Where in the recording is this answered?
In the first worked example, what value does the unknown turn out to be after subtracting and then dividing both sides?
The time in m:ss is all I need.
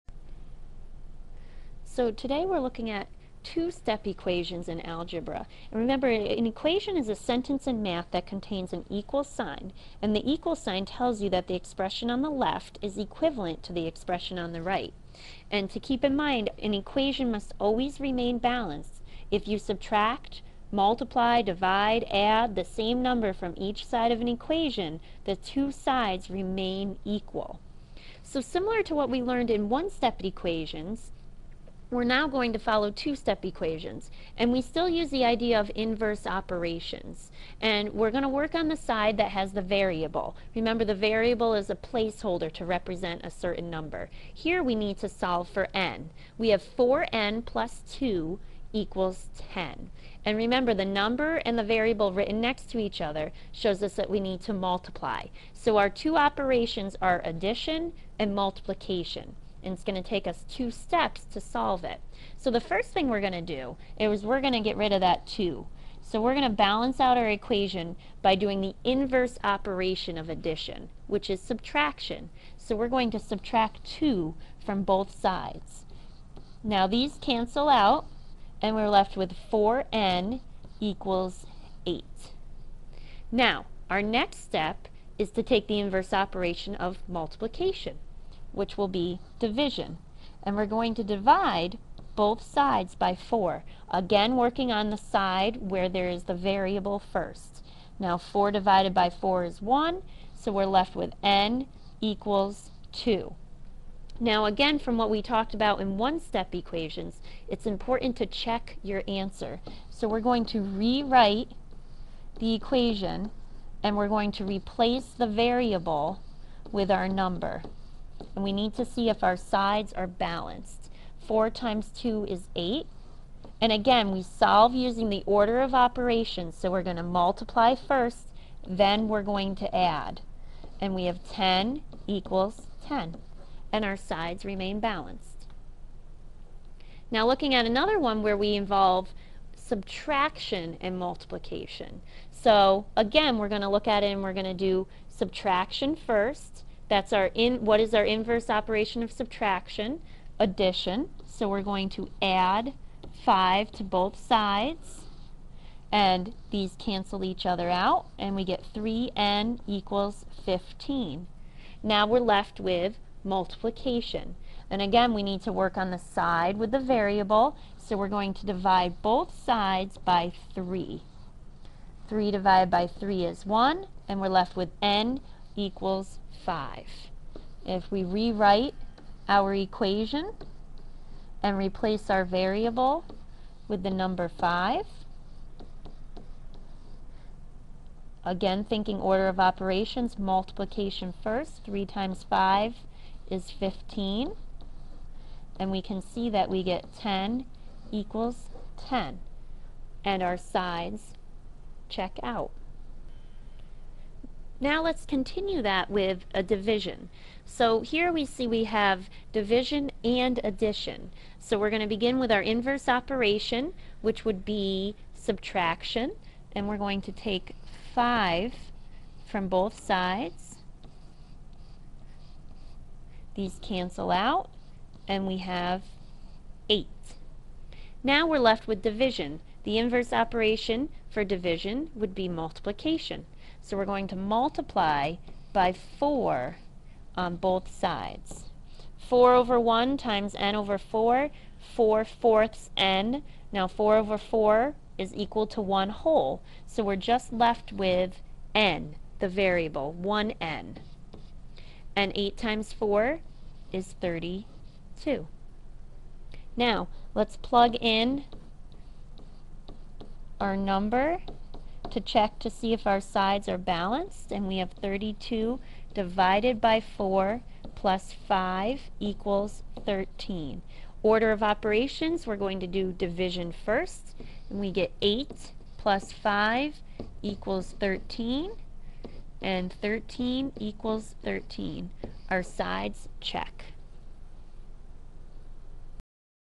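1:41.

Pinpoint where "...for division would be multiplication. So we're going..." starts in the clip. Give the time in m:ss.
3:51.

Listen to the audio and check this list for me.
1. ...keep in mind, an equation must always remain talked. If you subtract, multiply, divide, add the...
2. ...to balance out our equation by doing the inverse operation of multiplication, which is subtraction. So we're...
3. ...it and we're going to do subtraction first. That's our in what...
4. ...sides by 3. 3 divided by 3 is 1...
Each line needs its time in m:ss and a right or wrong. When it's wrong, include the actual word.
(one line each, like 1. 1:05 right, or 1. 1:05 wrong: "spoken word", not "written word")
1. 0:15 wrong: "balanced", not "talked"
2. 1:06 wrong: "addition", not "multiplication"
3. 2:24 right
4. 2:49 right.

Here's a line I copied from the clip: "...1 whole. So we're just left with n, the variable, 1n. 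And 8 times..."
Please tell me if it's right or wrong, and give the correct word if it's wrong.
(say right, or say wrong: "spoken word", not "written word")
right.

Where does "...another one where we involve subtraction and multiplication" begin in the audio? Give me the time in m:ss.
2:17.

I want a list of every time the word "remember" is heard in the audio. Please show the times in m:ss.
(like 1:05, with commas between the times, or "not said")
0:05, 0:40, 0:50.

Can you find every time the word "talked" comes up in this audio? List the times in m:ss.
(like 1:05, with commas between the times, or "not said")
1:45.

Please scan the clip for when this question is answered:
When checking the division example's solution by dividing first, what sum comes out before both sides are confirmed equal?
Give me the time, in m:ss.
4:35.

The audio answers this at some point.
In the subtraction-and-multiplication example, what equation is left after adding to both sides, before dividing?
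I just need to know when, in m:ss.
2:38.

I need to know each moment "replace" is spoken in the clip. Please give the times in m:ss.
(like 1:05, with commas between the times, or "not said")
1:54, 3:01.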